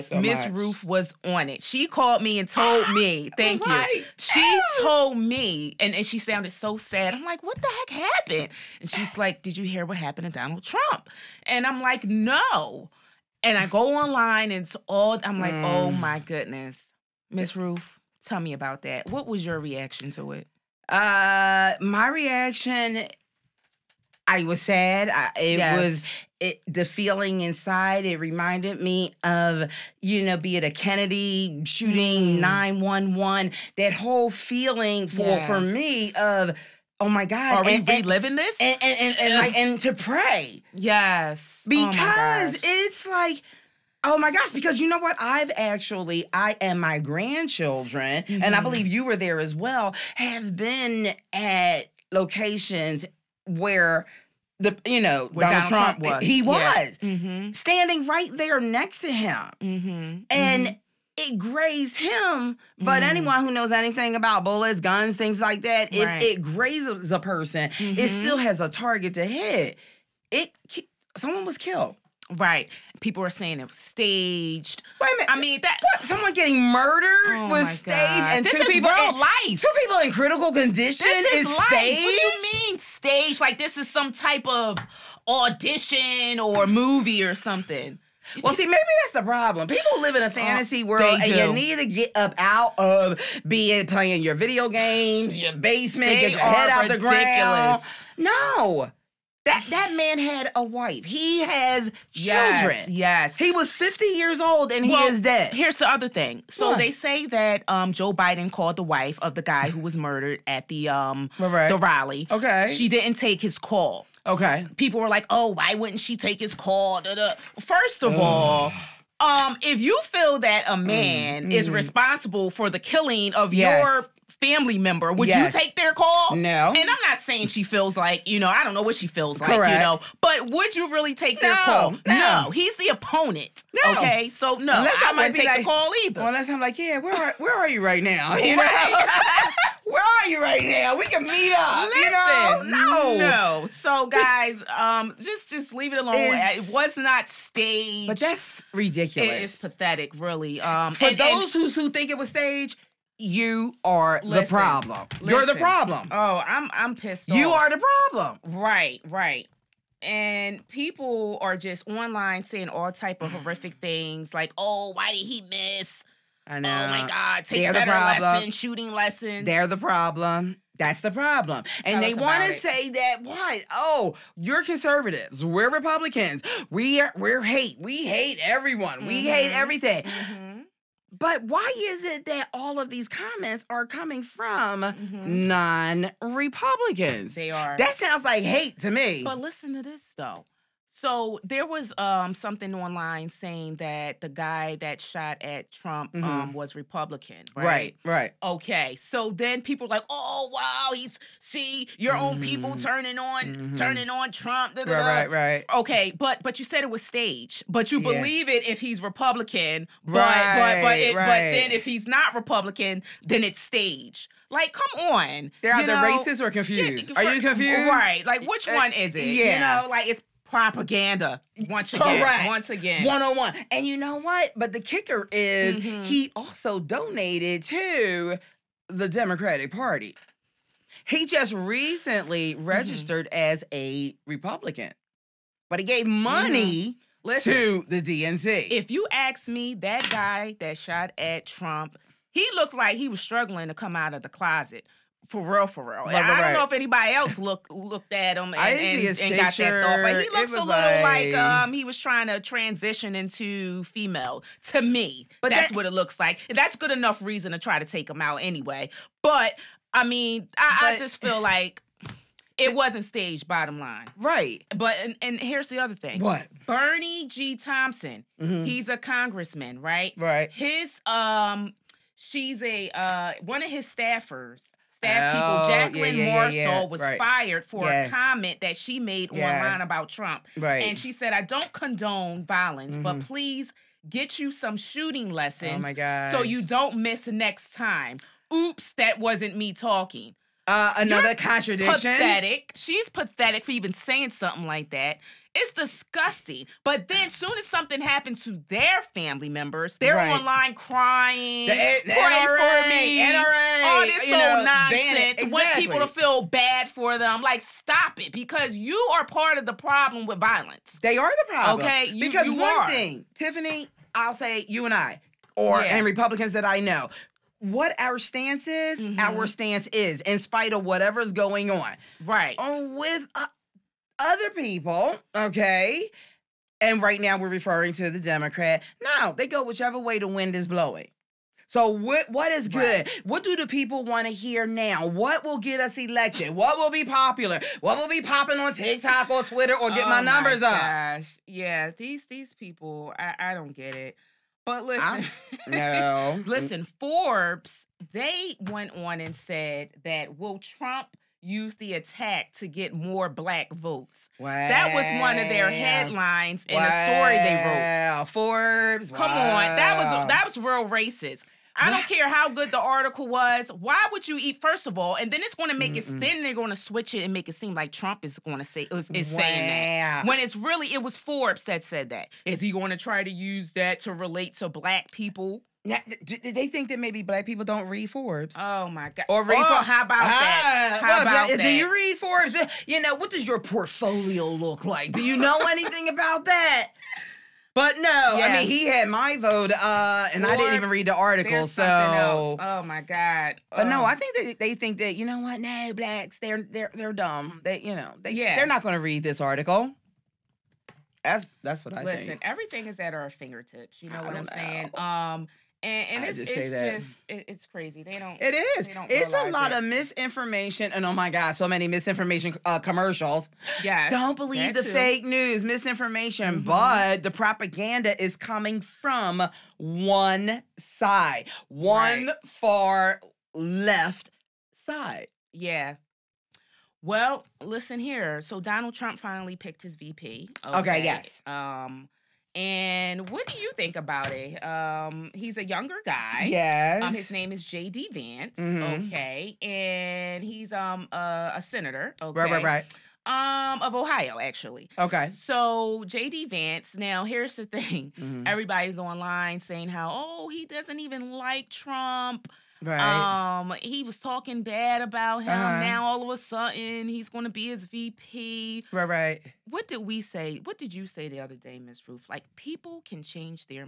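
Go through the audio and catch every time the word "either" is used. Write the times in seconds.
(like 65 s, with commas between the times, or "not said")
136 s, 215 s.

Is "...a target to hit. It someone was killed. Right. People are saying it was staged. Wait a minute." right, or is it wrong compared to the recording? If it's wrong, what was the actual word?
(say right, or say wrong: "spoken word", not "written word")
right.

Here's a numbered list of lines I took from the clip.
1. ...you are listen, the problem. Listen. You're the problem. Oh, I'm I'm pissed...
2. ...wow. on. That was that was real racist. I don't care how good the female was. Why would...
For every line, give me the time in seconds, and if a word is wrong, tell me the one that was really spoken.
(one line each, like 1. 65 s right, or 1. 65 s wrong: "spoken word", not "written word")
1. 153 s right
2. 359 s wrong: "article", not "female".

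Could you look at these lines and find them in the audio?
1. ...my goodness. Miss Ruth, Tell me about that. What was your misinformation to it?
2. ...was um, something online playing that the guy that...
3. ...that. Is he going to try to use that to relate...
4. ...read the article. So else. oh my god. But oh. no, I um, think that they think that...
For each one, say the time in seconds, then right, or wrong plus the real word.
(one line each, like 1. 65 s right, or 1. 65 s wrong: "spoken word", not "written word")
1. 15 s wrong: "reaction", not "misinformation"
2. 191 s wrong: "saying", not "playing"
3. 372 s right
4. 390 s right.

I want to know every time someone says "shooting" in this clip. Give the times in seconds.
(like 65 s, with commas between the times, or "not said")
31 s, 168 s, 284 s.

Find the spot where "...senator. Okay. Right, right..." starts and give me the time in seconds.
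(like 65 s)
441 s.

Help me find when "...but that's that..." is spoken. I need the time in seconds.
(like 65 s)
255 s.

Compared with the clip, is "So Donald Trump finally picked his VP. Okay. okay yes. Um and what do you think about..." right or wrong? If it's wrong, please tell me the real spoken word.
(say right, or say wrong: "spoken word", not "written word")
right.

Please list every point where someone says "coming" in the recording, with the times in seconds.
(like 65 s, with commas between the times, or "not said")
183 s, 418 s.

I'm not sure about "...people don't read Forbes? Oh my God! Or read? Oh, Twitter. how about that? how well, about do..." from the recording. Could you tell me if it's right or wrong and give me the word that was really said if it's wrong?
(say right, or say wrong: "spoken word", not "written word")
wrong: "Forbes", not "Twitter".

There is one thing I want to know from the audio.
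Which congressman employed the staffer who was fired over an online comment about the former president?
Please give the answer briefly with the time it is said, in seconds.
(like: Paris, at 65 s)
Bennie G. Thompson, at 266 s.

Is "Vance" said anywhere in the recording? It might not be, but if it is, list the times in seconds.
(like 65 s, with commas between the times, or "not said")
438 s, 446 s.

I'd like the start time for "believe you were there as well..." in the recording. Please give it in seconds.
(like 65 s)
48 s.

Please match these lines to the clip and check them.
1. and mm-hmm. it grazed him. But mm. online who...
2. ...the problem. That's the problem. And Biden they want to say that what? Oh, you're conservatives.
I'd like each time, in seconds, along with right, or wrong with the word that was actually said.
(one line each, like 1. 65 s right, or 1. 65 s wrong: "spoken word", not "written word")
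1. 60 s wrong: "anyone", not "online"
2. 169 s wrong: "Tell", not "Biden".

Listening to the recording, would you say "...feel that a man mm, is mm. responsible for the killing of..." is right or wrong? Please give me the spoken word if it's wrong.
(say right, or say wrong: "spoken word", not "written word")
right.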